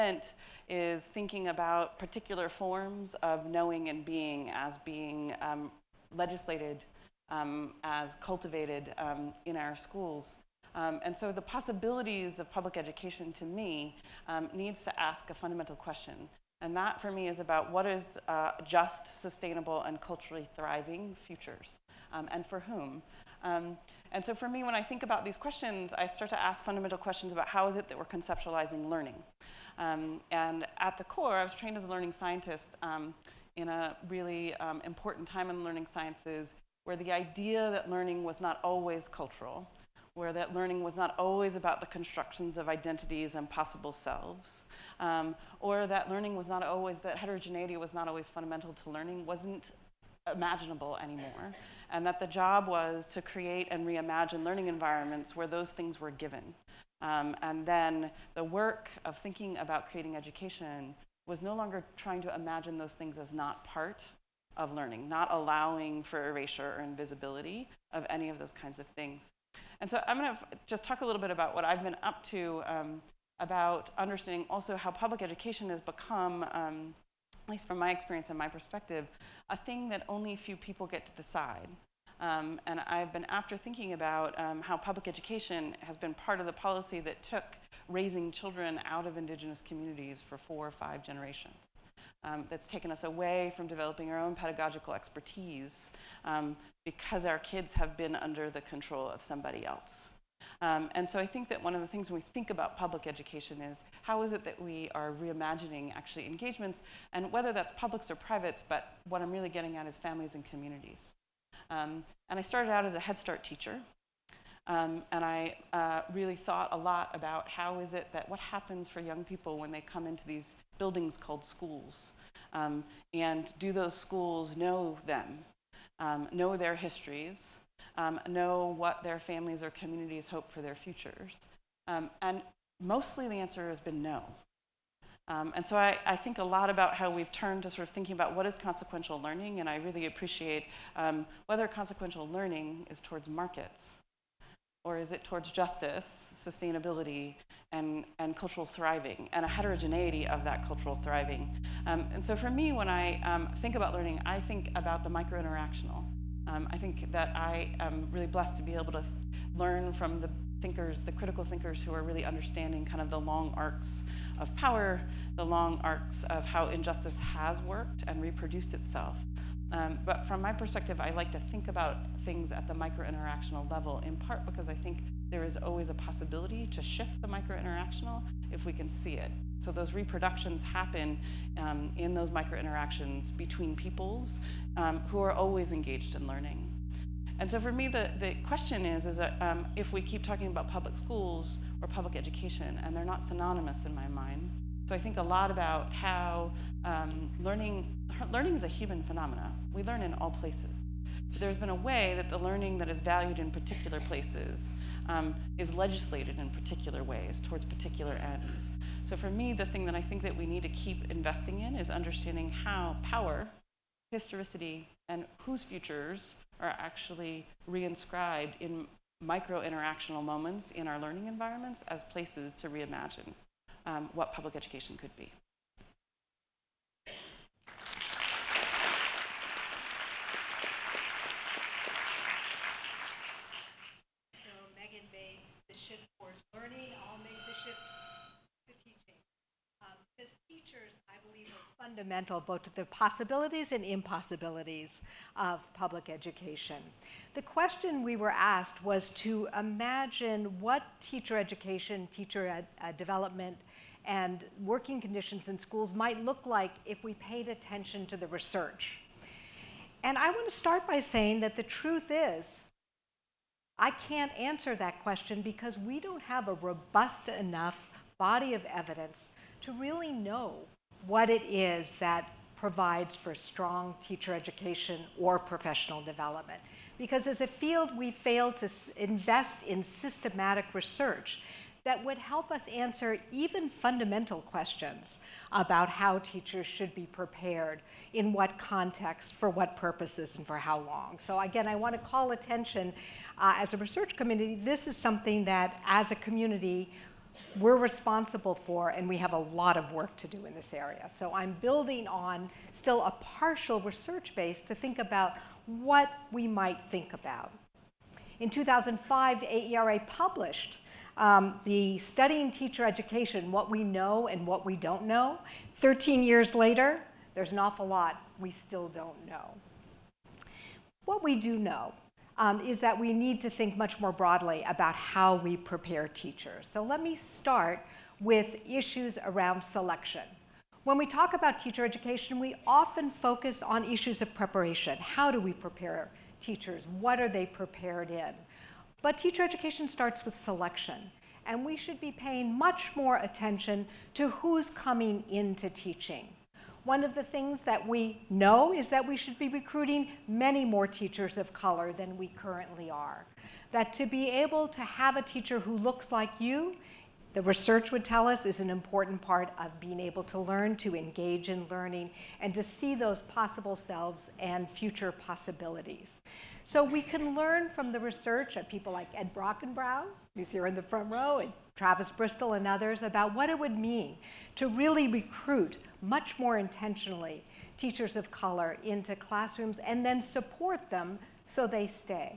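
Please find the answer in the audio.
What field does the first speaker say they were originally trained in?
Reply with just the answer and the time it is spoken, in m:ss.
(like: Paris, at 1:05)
learning sciences, at 0:31.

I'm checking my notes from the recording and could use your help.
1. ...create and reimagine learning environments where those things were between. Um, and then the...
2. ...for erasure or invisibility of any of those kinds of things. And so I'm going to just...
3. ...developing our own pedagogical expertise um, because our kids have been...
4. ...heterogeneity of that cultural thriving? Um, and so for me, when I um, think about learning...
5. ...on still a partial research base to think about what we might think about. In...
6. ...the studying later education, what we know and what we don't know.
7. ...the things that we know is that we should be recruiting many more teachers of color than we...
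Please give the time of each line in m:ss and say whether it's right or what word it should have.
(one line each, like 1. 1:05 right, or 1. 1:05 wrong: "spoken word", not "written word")
1. 0:53 wrong: "given", not "between"
2. 1:06 right
3. 1:33 right
4. 2:29 right
5. 5:02 right
6. 5:11 wrong: "teacher", not "later"
7. 5:47 right.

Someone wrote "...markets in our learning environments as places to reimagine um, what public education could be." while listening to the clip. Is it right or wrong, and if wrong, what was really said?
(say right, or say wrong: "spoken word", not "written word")
wrong: "moments", not "markets".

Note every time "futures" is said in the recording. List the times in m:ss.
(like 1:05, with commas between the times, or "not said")
0:21, 2:10, 3:35, 6:04.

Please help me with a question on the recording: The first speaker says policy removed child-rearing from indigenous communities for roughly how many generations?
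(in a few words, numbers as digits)
4 or 5.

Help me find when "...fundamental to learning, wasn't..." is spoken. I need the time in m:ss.
0:48.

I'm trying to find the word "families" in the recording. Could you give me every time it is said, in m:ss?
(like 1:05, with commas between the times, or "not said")
1:49, 2:09.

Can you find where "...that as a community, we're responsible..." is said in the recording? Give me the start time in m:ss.
4:55.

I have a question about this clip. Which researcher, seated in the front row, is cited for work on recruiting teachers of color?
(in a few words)
Ed Brockenbrough.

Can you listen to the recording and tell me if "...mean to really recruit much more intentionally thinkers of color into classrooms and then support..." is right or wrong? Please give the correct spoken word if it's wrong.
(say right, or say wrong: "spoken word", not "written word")
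wrong: "teachers", not "thinkers".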